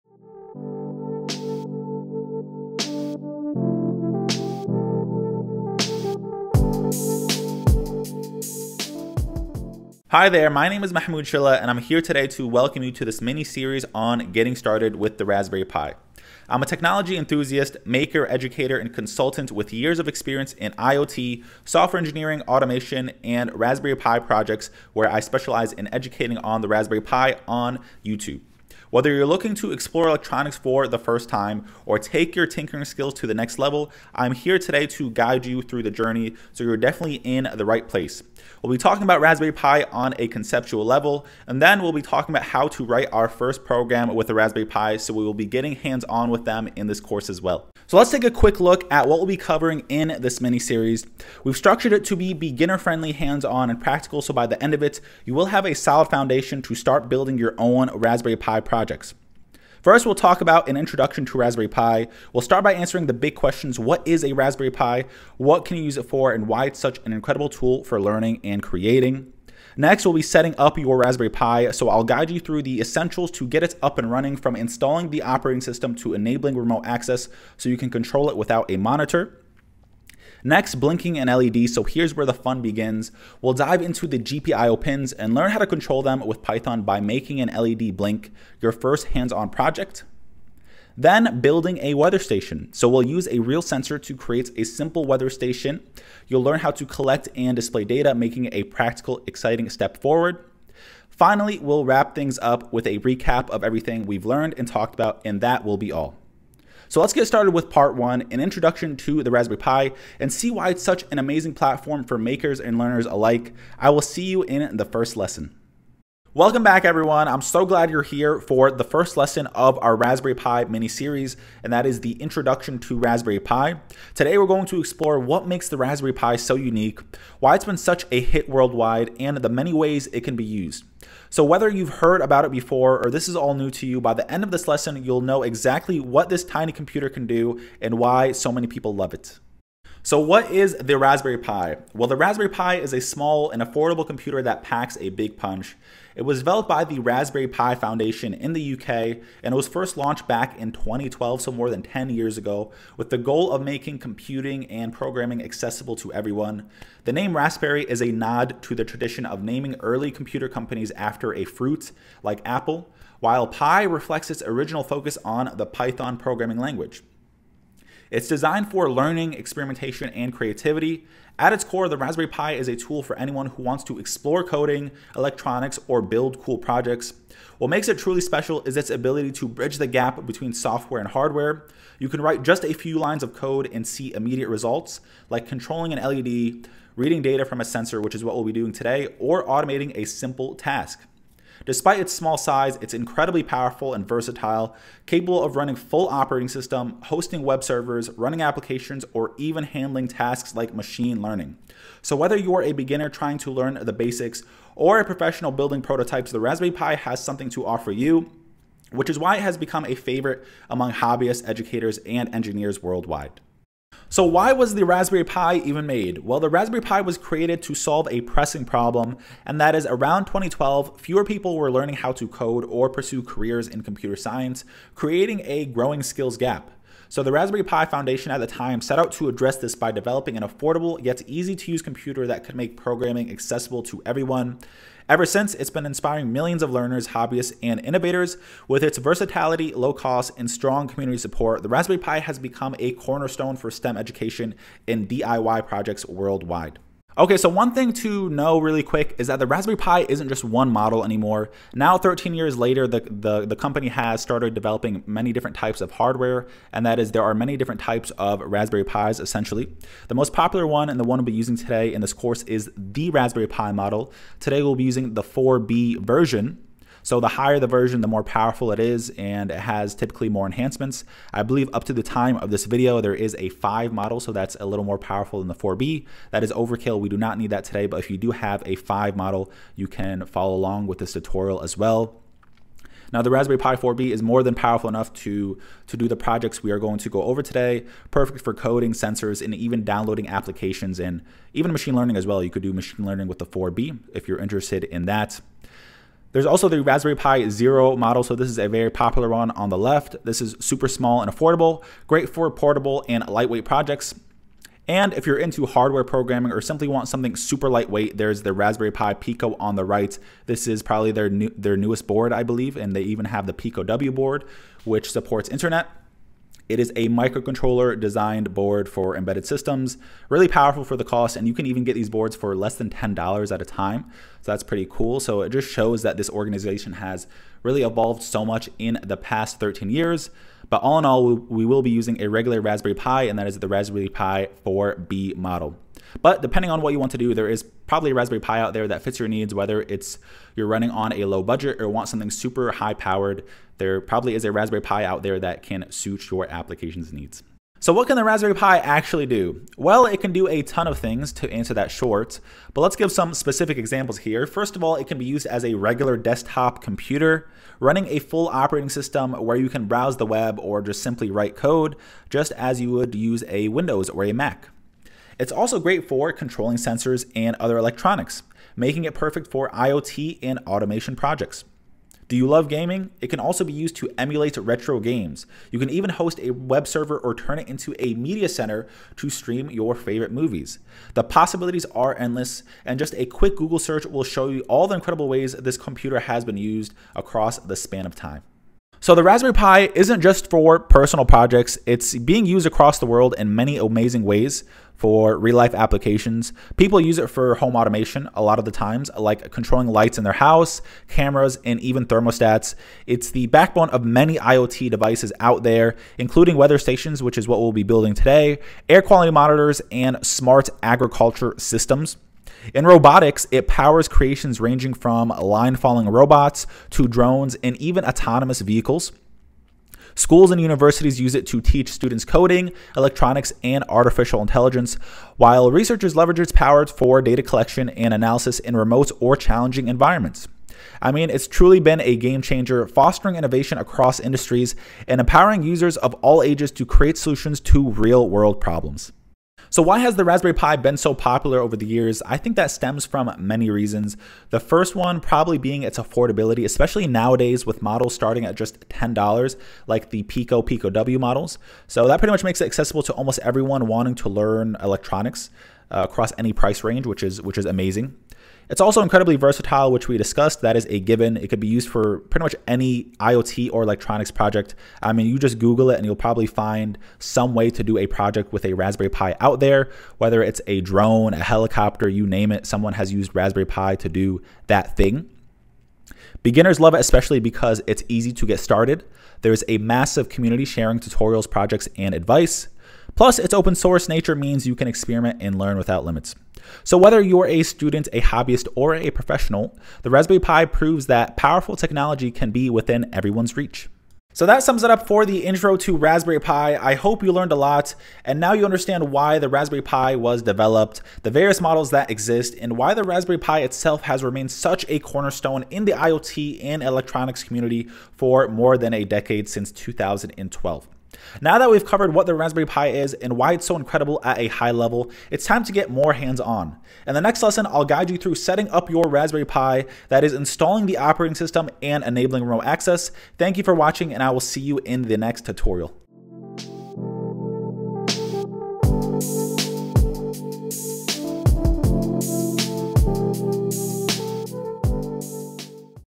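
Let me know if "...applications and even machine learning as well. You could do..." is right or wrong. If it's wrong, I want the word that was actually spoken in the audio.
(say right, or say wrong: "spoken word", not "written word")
right.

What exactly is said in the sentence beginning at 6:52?
In robotics, it powers creations ranging from line following robots to drones and even autonomous vehicles.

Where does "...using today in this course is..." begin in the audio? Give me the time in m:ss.
4:21.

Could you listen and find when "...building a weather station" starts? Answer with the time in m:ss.
1:31.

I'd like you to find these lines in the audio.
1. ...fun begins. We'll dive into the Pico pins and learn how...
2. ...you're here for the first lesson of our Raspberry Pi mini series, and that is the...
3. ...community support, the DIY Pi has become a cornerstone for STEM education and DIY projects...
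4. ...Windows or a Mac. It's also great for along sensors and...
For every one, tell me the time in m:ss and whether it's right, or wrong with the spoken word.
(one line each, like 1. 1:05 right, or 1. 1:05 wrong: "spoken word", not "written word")
1. 1:22 wrong: "GPIO", not "Pico"
2. 1:57 right
3. 4:00 wrong: "Raspberry", not "DIY"
4. 6:03 wrong: "controlling", not "along".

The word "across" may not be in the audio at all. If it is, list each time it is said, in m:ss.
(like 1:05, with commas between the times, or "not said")
6:27, 6:32, 7:13, 7:36.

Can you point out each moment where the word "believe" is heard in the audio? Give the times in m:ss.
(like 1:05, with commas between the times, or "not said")
4:31, 5:12.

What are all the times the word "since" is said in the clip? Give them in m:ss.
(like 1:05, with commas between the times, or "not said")
3:55, 8:29.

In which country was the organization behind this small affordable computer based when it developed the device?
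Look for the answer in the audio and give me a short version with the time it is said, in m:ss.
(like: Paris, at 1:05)
UK, at 2:28.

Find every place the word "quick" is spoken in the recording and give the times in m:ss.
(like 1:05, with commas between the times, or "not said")
0:48, 4:08, 6:23.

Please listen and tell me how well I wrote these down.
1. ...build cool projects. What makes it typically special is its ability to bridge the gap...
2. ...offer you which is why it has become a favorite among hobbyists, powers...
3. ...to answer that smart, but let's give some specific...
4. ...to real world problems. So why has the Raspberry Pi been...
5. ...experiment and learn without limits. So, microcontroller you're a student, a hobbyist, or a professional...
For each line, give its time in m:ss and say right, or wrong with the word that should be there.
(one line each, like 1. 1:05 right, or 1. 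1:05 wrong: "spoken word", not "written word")
1. 2:56 wrong: "truly", not "typically"
2. 3:27 wrong: "educators", not "powers"
3. 5:51 wrong: "short", not "smart"
4. 7:17 right
5. 8:04 wrong: "whether", not "microcontroller".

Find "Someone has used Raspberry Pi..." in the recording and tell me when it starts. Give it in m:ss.
7:52.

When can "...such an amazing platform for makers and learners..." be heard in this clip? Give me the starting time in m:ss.
1:50.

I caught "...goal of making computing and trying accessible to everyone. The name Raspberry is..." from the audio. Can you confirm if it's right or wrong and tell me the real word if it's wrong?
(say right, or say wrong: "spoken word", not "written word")
wrong: "programming", not "trying".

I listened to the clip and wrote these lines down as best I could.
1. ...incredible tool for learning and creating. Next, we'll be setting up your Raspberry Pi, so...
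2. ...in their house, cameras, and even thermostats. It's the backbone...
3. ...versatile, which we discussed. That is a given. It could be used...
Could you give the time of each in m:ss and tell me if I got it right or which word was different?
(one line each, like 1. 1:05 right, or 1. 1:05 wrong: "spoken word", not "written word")
1. 1:07 right
2. 6:40 right
3. 7:39 right.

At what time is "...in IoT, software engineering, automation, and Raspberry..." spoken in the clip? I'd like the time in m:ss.
0:20.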